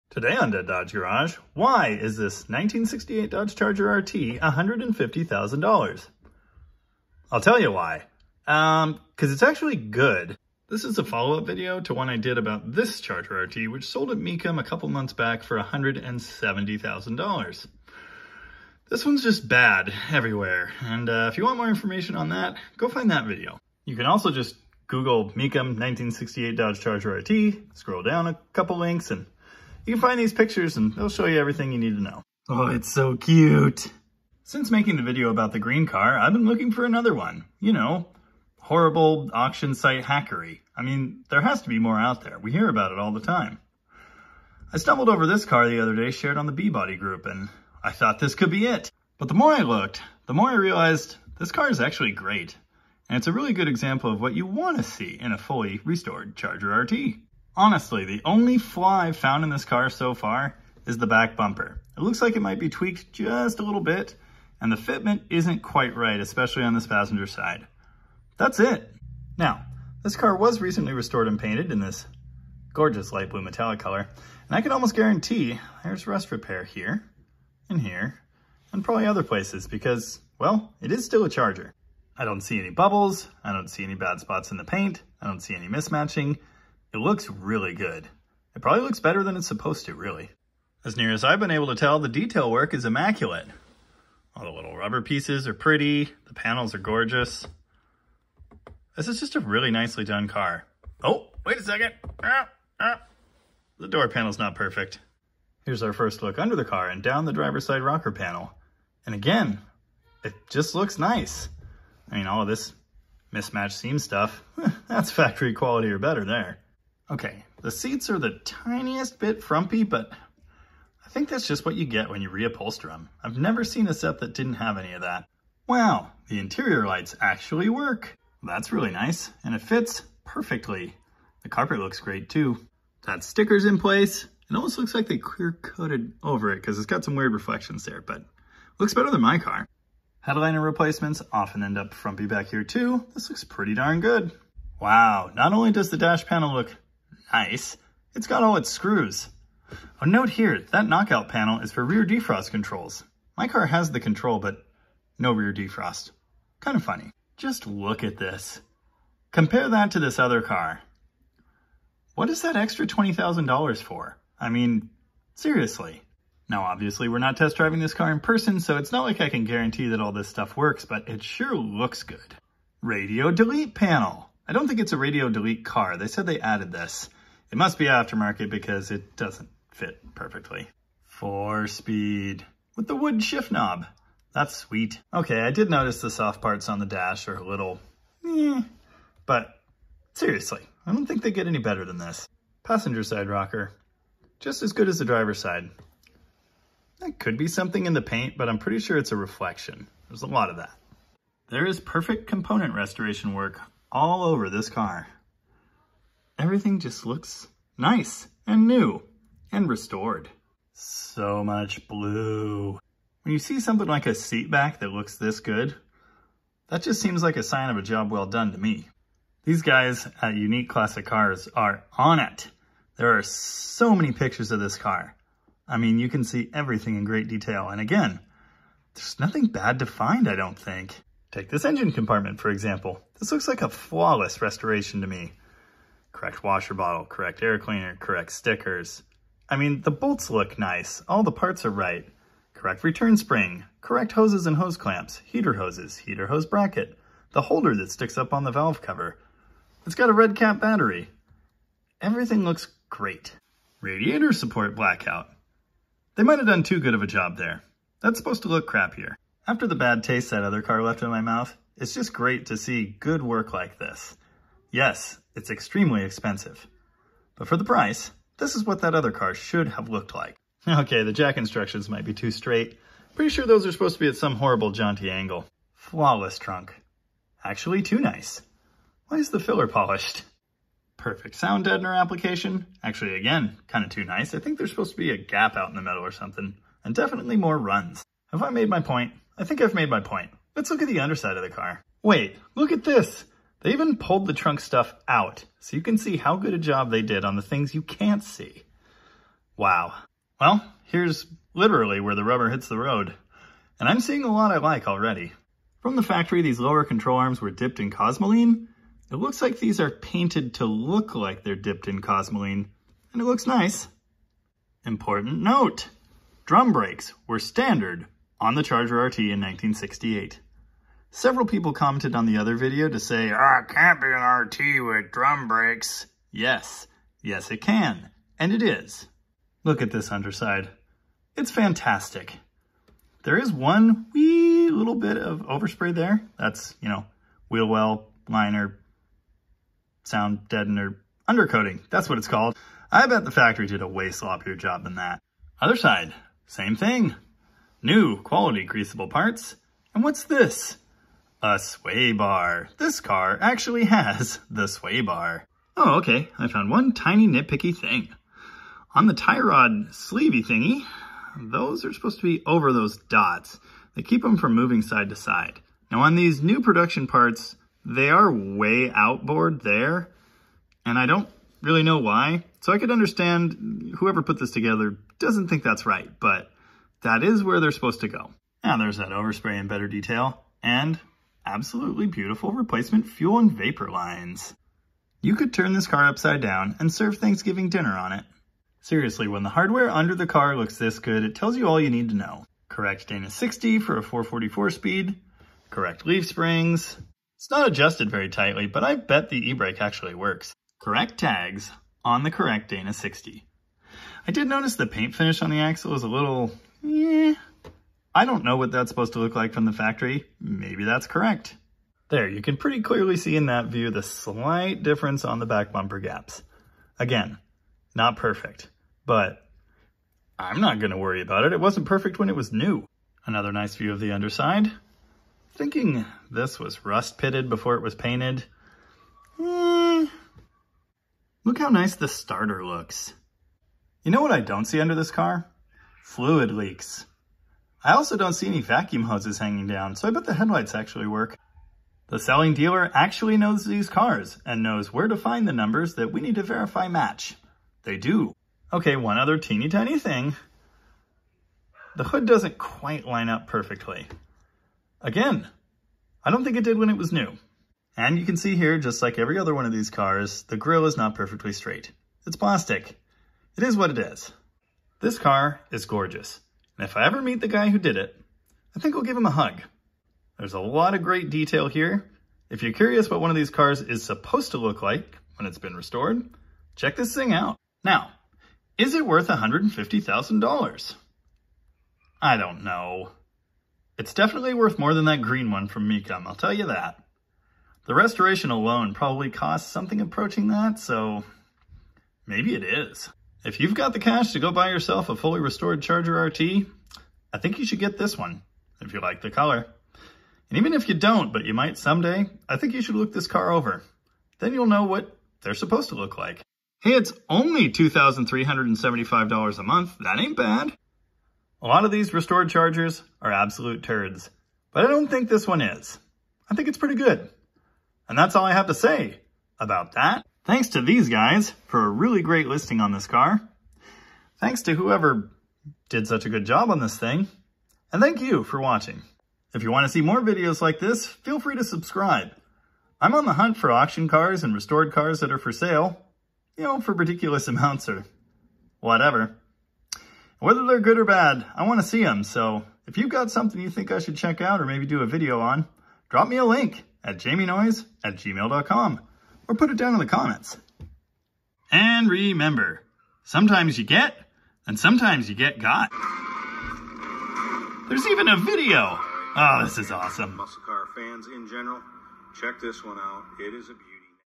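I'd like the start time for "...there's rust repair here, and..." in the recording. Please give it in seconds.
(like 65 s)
75 s.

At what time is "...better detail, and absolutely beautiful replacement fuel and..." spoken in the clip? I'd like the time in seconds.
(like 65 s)
379 s.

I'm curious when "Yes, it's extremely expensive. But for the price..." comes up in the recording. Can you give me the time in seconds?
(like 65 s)
264 s.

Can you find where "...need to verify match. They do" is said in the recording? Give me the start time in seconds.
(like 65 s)
446 s.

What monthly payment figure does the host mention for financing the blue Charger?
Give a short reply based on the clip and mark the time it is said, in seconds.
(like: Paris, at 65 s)
$2,375, at 507 s.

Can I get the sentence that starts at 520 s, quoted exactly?
Thanks to these guys for a really great listing on this car.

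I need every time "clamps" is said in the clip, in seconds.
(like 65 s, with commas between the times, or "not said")
244 s.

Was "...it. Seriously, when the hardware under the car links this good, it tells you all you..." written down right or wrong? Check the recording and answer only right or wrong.
wrong.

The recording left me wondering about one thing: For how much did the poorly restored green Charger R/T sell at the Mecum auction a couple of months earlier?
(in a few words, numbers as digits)
$170,000.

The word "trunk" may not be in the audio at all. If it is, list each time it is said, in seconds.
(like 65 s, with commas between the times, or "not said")
276 s, 294 s.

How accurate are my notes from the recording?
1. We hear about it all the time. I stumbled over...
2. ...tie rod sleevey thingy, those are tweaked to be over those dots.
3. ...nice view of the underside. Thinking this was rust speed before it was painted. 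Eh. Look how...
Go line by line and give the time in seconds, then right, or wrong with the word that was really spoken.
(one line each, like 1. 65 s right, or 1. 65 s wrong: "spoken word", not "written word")
1. 42 s right
2. 359 s wrong: "supposed", not "tweaked"
3. 423 s wrong: "pitted", not "speed".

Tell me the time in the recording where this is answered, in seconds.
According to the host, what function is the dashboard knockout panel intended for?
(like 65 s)
151 s.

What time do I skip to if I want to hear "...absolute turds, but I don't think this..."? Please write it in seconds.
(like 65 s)
513 s.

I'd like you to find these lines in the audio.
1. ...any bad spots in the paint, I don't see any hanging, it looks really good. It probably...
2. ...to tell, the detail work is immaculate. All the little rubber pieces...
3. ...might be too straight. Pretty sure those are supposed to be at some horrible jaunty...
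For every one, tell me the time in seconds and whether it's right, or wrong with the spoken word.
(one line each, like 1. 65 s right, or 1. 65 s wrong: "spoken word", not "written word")
1. 83 s wrong: "mismatching", not "hanging"
2. 91 s right
3. 271 s right.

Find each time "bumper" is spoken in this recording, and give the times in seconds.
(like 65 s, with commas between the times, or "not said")
61 s, 415 s.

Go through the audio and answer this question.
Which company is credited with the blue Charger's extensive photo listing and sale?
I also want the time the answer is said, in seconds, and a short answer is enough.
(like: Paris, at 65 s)
Unique Classic Cars, at 220 s.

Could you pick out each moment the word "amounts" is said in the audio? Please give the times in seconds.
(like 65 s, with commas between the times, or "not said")
537 s.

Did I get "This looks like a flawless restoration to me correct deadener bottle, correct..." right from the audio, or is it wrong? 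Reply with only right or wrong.
wrong.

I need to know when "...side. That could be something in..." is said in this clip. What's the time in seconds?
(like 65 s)
195 s.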